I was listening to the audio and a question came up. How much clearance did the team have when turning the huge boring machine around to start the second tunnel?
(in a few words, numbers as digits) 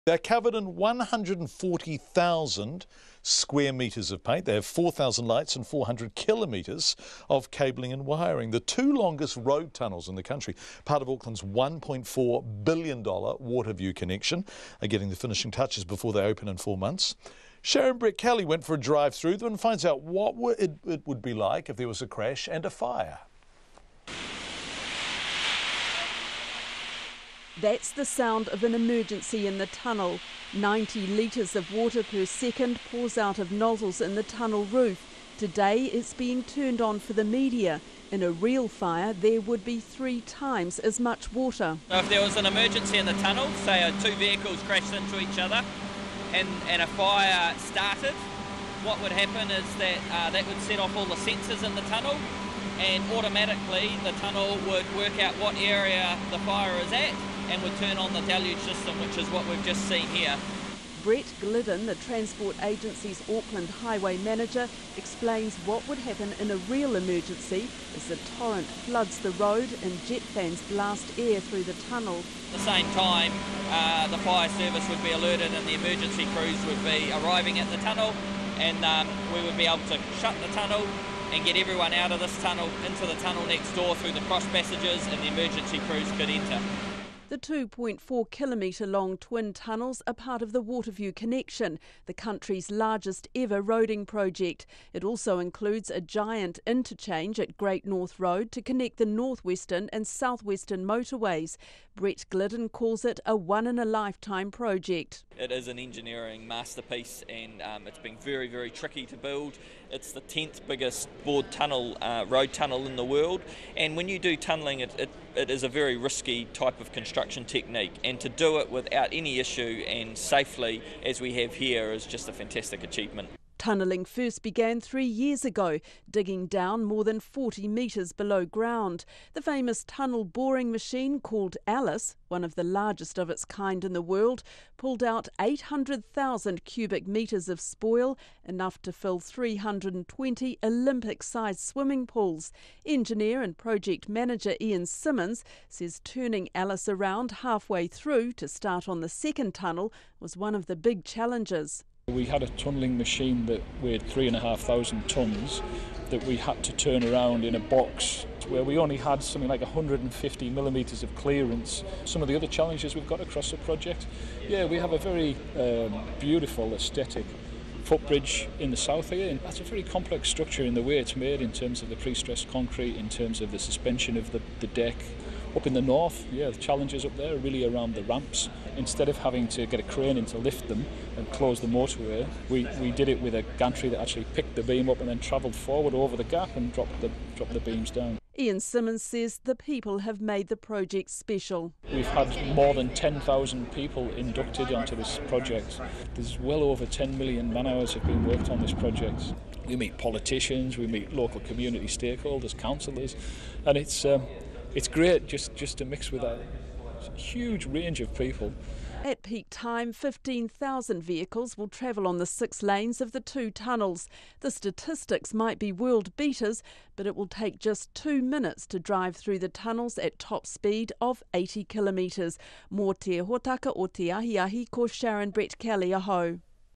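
150 millimetres.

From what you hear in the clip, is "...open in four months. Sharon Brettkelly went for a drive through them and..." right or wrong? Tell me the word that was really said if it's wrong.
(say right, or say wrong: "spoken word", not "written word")
right.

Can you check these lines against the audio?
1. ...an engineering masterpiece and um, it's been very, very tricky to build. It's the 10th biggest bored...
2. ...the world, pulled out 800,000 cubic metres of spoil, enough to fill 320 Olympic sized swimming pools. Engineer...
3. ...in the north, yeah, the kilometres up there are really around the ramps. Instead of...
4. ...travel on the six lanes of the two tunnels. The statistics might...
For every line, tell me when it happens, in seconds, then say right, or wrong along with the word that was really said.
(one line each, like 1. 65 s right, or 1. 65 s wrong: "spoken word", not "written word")
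1. 105 s right
2. 133 s right
3. 175 s wrong: "challenges", not "kilometres"
4. 211 s right.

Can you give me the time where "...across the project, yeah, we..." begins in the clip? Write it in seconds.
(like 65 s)
163 s.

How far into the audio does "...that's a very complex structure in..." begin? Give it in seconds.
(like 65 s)
169 s.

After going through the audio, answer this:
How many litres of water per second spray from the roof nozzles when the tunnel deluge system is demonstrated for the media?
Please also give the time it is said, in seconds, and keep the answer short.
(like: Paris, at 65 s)
90, at 30 s.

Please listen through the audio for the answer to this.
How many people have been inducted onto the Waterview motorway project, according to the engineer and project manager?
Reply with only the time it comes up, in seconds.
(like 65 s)
192 s.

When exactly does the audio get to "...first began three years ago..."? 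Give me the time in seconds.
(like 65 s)
124 s.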